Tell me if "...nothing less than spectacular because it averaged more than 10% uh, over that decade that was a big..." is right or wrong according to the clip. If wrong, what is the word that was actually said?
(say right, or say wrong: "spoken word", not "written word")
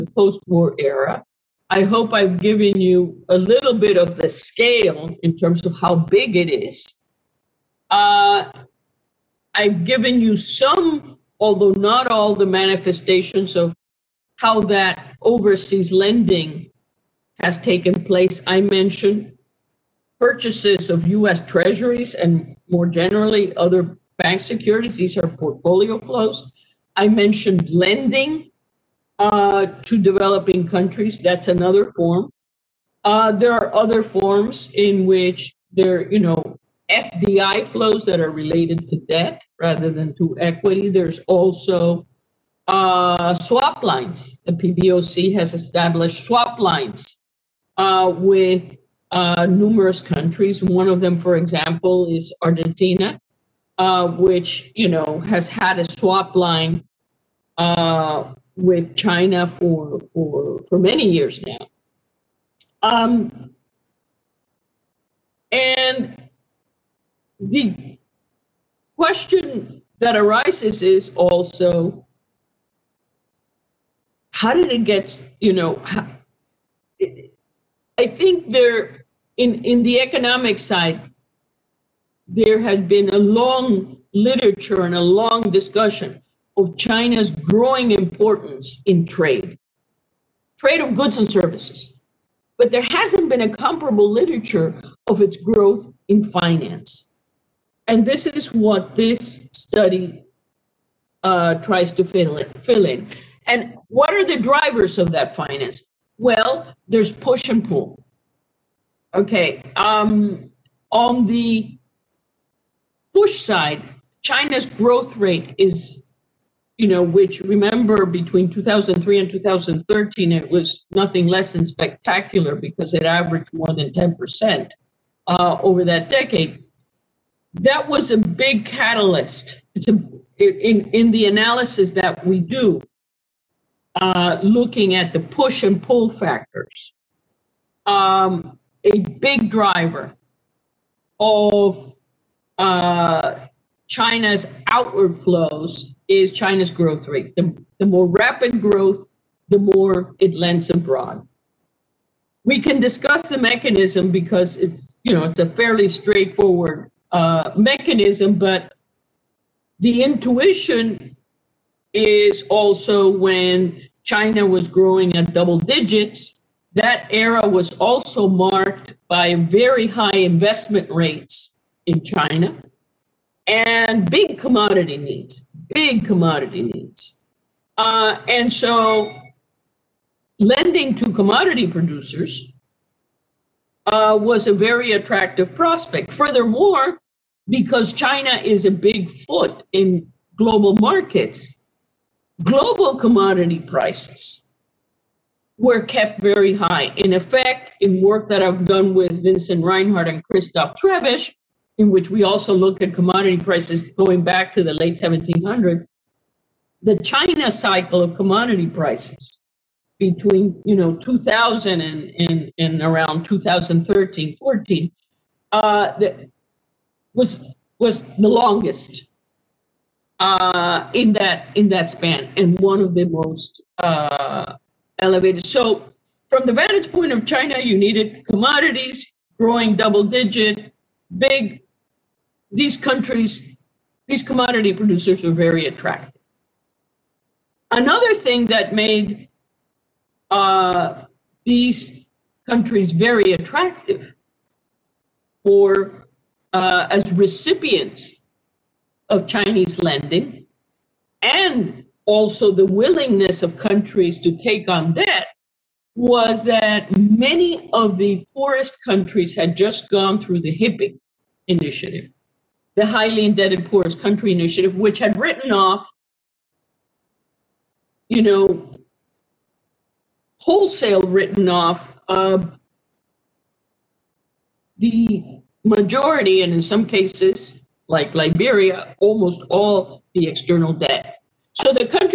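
right.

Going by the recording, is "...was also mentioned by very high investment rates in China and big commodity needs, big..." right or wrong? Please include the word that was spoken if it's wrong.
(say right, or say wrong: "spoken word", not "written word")
wrong: "marked", not "mentioned".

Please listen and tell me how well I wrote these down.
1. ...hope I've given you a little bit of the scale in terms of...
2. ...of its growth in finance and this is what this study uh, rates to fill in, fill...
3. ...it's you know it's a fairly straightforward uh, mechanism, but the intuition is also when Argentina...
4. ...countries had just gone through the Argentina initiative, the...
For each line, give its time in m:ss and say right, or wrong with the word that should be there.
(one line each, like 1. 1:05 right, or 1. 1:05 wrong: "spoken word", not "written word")
1. 0:01 right
2. 1:35 wrong: "tries", not "rates"
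3. 2:34 wrong: "China", not "Argentina"
4. 4:18 wrong: "HIPC", not "Argentina".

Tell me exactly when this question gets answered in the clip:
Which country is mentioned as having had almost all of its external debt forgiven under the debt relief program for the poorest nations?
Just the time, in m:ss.
4:38.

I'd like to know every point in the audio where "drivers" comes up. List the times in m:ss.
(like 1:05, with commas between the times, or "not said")
1:44, 2:19.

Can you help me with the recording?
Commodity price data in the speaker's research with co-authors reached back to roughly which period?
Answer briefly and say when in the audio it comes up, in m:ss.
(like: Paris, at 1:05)
late 1700s, at 3:24.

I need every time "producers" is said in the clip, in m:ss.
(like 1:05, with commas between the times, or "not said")
3:01, 3:54.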